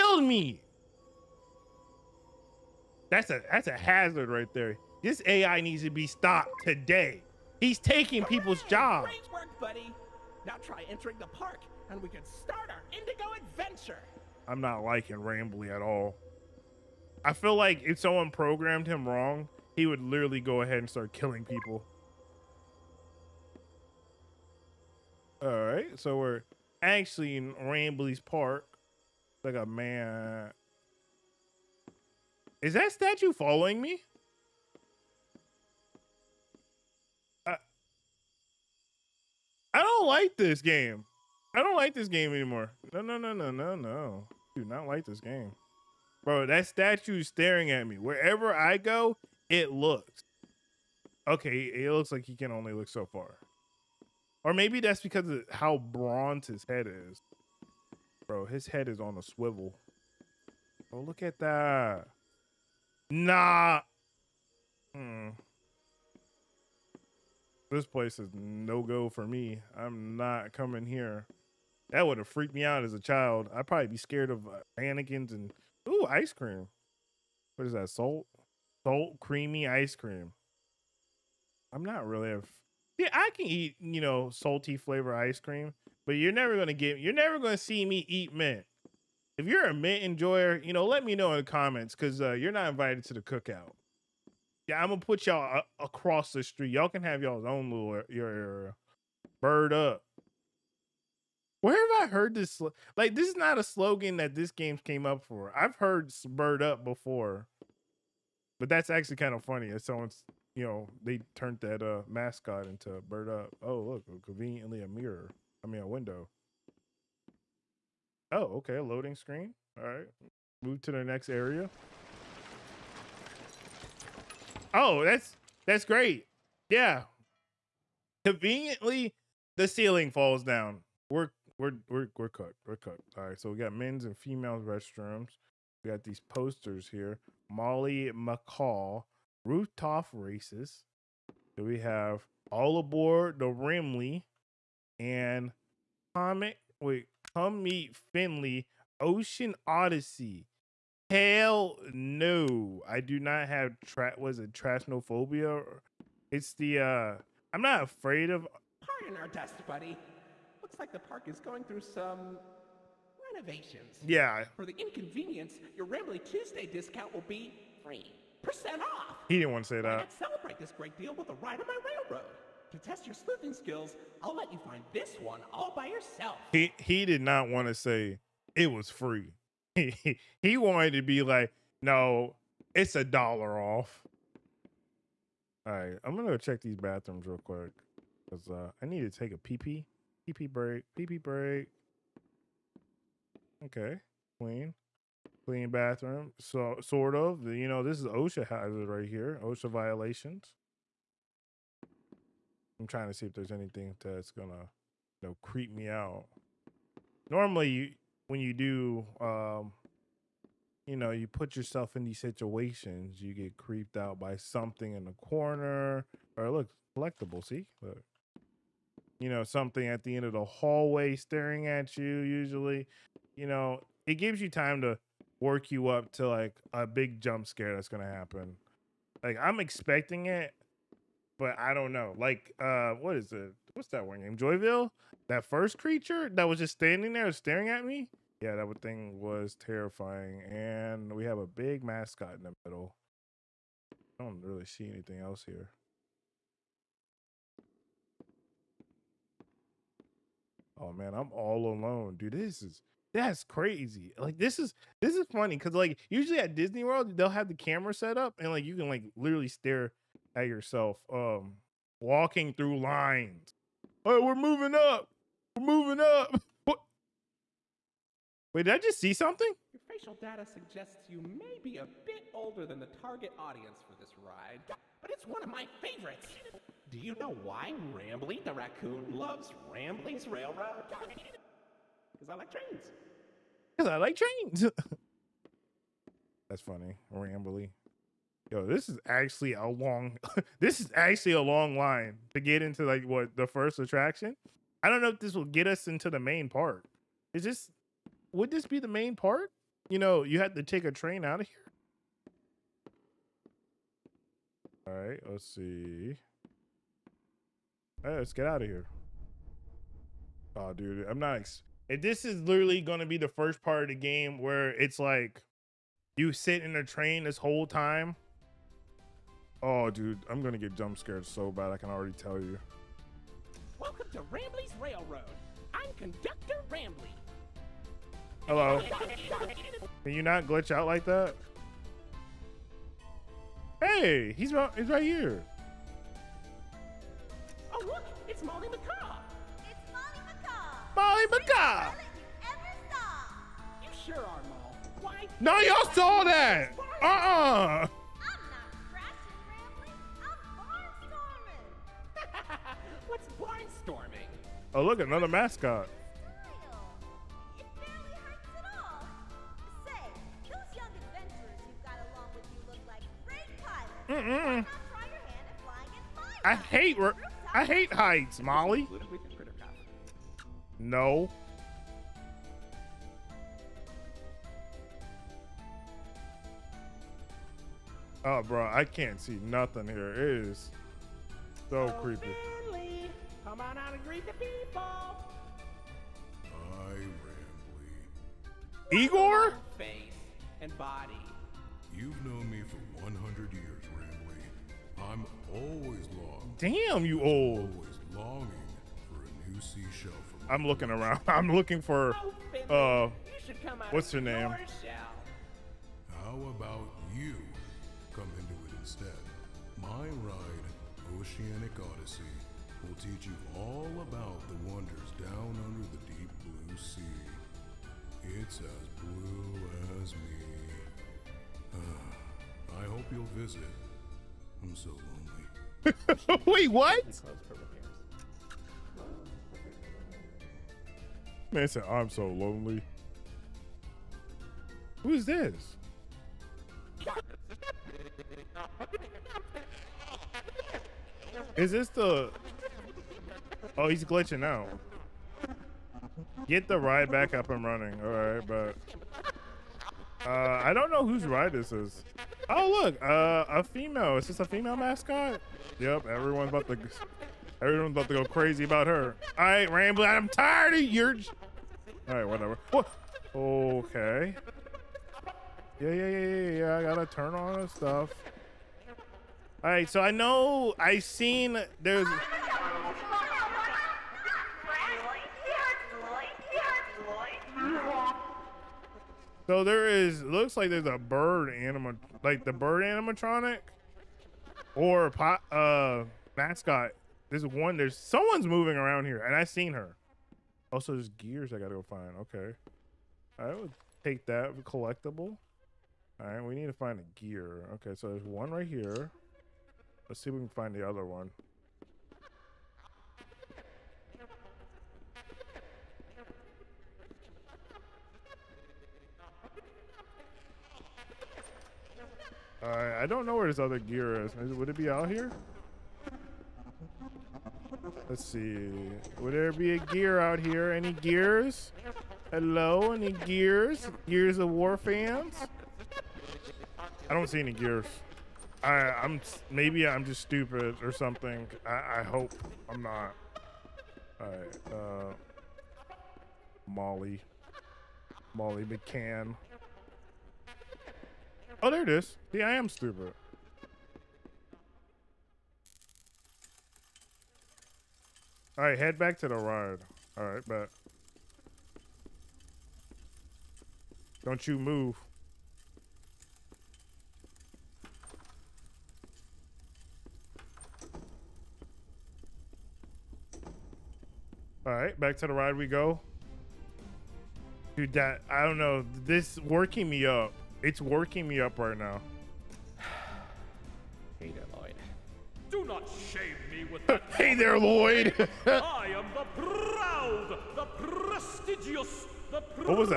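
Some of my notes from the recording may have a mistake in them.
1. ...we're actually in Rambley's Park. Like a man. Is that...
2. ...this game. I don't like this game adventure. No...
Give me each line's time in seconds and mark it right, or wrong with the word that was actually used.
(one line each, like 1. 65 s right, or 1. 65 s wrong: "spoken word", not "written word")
1. 26 s right
2. 40 s wrong: "anymore", not "adventure".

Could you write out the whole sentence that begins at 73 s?
I'd probably be scared of mannequins and Ooh, ice cream.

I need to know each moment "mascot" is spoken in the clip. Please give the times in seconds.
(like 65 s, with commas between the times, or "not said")
112 s, 241 s, 454 s, 486 s.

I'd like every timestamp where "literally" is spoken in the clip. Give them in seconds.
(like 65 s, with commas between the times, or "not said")
20 s, 259 s, 312 s.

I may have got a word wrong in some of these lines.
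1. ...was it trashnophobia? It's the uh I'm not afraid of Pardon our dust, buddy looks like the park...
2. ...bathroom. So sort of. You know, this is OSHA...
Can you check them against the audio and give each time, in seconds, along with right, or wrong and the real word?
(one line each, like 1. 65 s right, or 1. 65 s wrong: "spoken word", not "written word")
1. 154 s right
2. 195 s right.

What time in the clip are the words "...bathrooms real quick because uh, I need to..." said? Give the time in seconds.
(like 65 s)
186 s.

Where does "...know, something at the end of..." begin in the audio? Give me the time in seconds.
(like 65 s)
219 s.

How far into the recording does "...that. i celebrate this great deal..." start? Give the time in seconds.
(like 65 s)
169 s.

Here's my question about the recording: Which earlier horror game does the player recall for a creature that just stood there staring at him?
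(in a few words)
Joyville.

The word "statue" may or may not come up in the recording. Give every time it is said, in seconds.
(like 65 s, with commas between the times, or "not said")
32 s, 46 s.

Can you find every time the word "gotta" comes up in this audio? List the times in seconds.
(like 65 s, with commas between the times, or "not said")
466 s, 491 s.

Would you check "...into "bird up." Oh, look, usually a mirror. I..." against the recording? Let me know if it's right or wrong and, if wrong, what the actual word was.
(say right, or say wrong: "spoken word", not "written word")
wrong: "conveniently", not "usually".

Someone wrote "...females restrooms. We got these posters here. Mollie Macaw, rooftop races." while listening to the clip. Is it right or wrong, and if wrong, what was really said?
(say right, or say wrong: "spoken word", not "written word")
right.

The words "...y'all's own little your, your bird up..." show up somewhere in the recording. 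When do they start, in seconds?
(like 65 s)
97 s.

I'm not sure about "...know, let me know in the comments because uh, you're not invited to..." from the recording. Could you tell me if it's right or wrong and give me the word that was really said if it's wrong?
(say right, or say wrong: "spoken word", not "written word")
right.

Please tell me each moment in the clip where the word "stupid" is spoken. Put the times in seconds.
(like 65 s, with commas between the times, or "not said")
530 s, 542 s.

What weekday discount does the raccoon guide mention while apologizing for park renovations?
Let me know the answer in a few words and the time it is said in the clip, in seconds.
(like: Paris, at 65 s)
Rambley Tuesday, at 165 s.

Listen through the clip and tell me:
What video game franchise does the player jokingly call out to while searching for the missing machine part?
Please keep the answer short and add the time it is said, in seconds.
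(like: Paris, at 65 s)
Gears of War, at 524 s.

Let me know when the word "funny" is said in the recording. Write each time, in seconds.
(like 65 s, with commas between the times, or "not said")
109 s, 255 s, 286 s.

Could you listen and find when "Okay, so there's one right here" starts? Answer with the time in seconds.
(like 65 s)
497 s.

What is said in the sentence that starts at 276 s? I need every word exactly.
Do you know why Rambley the raccoon loves Rambley's railroad?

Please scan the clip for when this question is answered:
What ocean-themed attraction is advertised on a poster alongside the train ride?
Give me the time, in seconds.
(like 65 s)
149 s.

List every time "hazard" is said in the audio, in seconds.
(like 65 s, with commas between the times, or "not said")
3 s, 198 s.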